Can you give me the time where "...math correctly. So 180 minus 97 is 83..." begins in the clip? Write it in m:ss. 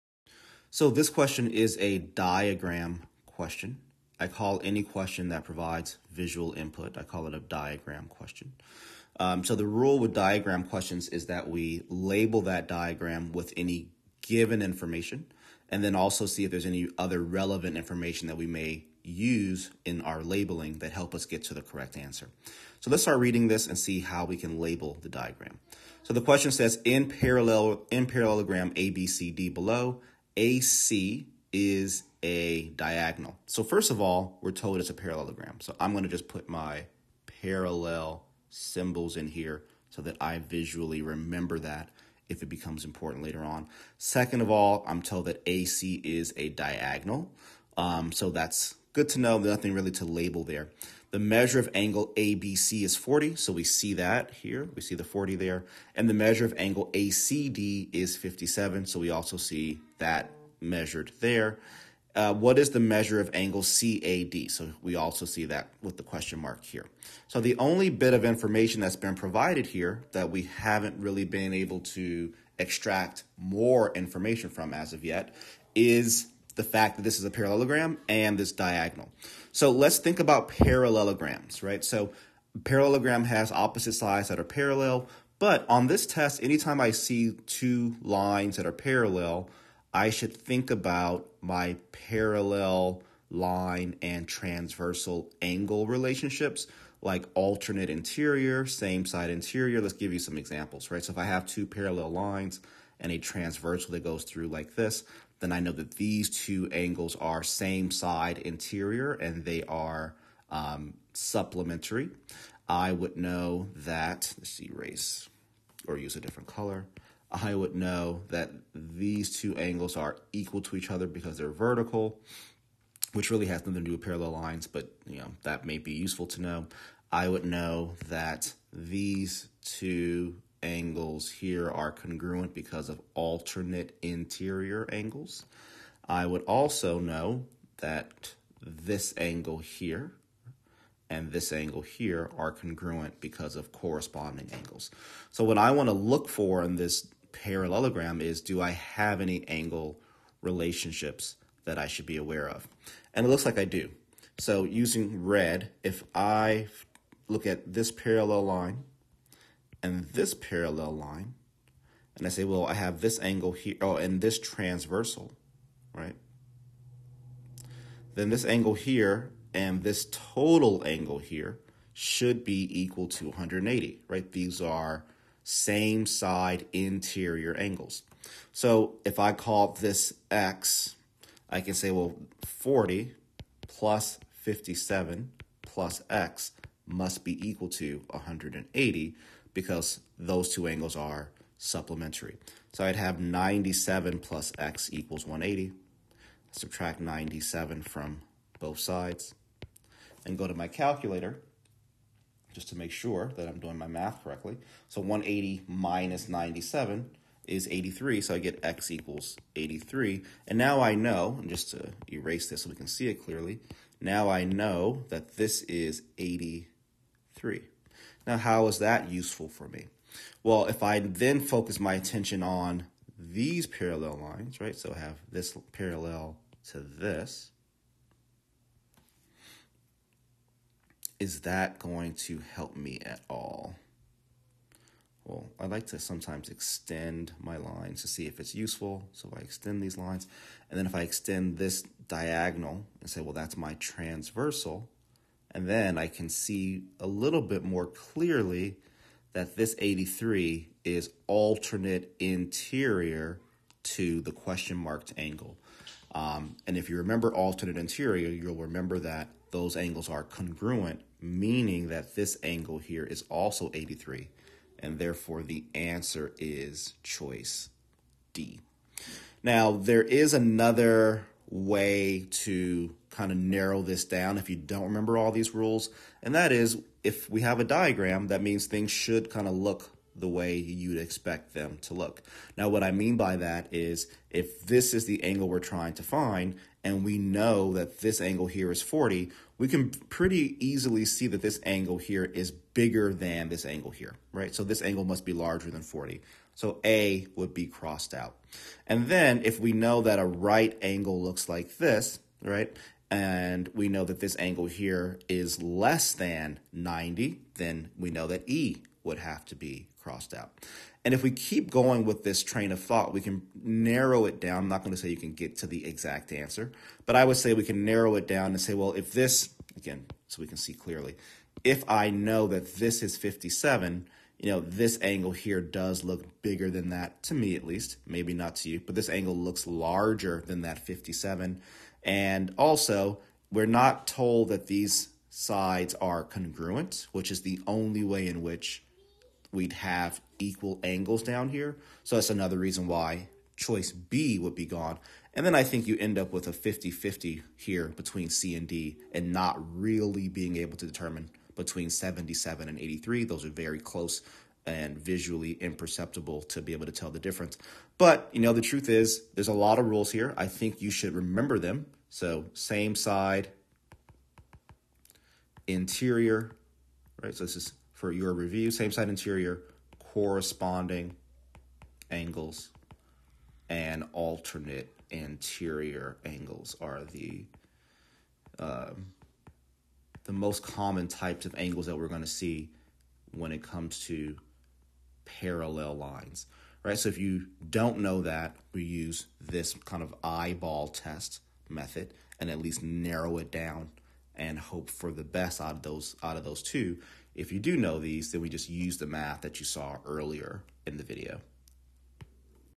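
3:23.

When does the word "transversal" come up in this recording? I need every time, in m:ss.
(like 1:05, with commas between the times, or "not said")
1:34, 1:43, 2:44, 4:03.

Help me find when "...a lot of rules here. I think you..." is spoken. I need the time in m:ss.
5:59.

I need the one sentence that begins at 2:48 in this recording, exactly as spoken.
Then this angle here and this total angle here should be equal to 180, right?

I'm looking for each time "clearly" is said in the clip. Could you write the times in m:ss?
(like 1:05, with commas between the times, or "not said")
3:33, 4:07, 5:20.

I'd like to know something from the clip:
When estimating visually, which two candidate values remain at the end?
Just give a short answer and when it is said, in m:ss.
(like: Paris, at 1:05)
77, at 5:51.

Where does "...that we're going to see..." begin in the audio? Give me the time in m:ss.
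6:21.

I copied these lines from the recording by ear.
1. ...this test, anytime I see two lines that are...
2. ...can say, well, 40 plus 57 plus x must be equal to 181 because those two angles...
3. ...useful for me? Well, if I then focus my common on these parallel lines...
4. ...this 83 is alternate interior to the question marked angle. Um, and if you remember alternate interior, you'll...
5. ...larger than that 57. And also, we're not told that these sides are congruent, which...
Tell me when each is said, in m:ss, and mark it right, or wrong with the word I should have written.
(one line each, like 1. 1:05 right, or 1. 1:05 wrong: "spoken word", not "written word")
1. 1:25 right
2. 3:01 wrong: "180", not "181"
3. 3:39 wrong: "attention", not "common"
4. 4:09 right
5. 5:29 right.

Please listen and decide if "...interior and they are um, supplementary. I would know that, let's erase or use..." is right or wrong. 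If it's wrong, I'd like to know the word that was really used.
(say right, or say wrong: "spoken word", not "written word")
right.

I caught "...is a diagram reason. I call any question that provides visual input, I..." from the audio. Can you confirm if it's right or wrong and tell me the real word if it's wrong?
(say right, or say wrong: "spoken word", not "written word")
wrong: "question", not "reason".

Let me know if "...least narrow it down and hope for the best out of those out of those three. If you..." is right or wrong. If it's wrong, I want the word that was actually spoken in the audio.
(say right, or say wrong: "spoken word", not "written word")
wrong: "two", not "three".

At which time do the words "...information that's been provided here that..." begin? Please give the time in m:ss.
1:08.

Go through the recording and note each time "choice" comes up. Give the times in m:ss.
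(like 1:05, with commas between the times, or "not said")
4:27, 5:43.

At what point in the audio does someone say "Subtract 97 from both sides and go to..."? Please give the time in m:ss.
3:16.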